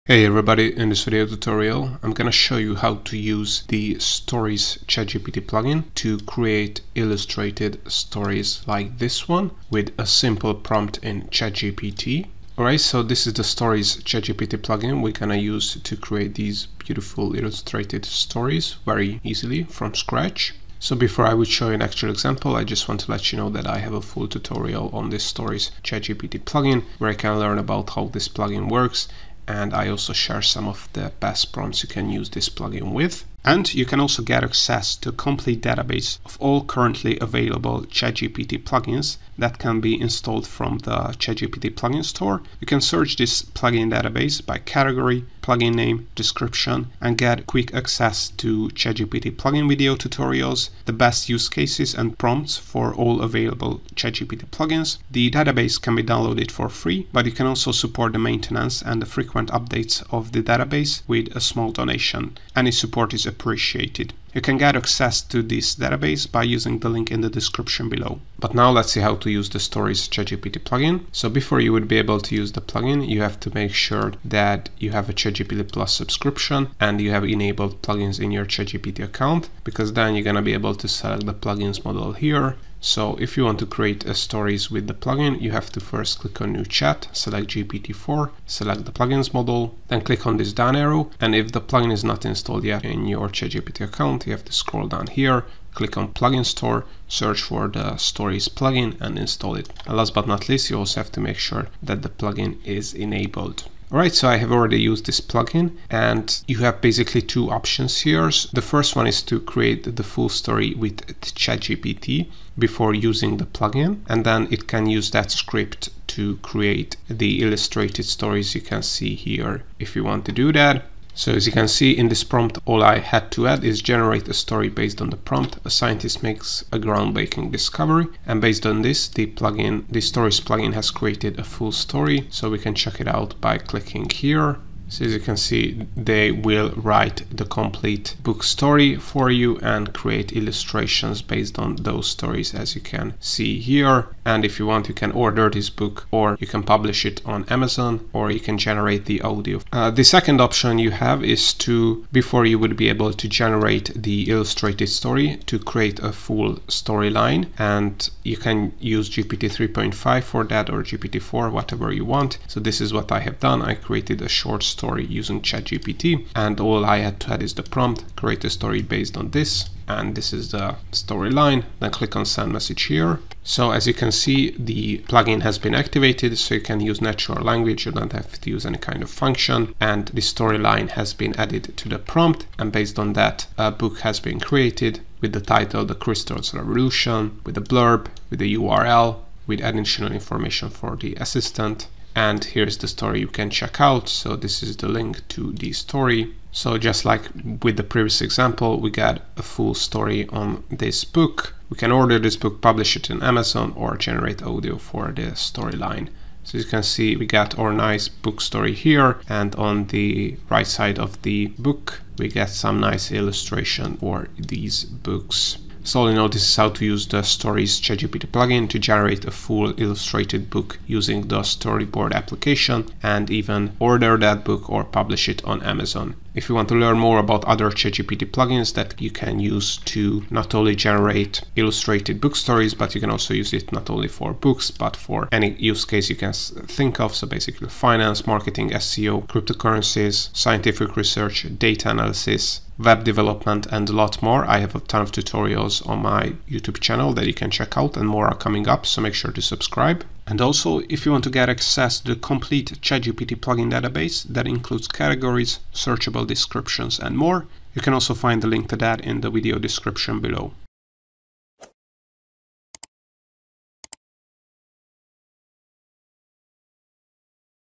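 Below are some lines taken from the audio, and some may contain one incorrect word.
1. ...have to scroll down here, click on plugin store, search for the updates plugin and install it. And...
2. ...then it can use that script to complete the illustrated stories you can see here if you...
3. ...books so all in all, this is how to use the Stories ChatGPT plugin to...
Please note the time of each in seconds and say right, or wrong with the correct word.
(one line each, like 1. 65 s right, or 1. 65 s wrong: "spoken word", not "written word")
1. 94 s wrong: "stories", not "updates"
2. 114 s wrong: "create", not "complete"
3. 214 s right.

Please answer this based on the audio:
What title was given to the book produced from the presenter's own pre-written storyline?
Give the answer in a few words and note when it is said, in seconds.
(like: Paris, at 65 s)
The Crystals Revolution, at 185 s.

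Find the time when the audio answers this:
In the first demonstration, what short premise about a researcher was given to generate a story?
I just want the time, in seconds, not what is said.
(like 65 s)
125 s.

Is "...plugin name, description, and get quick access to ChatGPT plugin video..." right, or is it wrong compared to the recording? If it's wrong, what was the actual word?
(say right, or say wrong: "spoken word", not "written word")
right.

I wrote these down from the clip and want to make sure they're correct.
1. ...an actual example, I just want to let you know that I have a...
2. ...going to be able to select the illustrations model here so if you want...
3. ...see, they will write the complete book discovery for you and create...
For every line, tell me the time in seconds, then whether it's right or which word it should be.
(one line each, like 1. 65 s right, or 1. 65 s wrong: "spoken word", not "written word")
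1. 21 s right
2. 80 s wrong: "plugins", not "illustrations"
3. 135 s wrong: "story", not "discovery".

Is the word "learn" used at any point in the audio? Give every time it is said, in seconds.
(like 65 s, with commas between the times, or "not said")
27 s, 226 s.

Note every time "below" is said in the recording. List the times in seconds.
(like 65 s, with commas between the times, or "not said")
67 s, 260 s.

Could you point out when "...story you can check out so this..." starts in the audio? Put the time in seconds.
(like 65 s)
192 s.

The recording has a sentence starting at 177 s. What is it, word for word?
You don't have to use any kind of function.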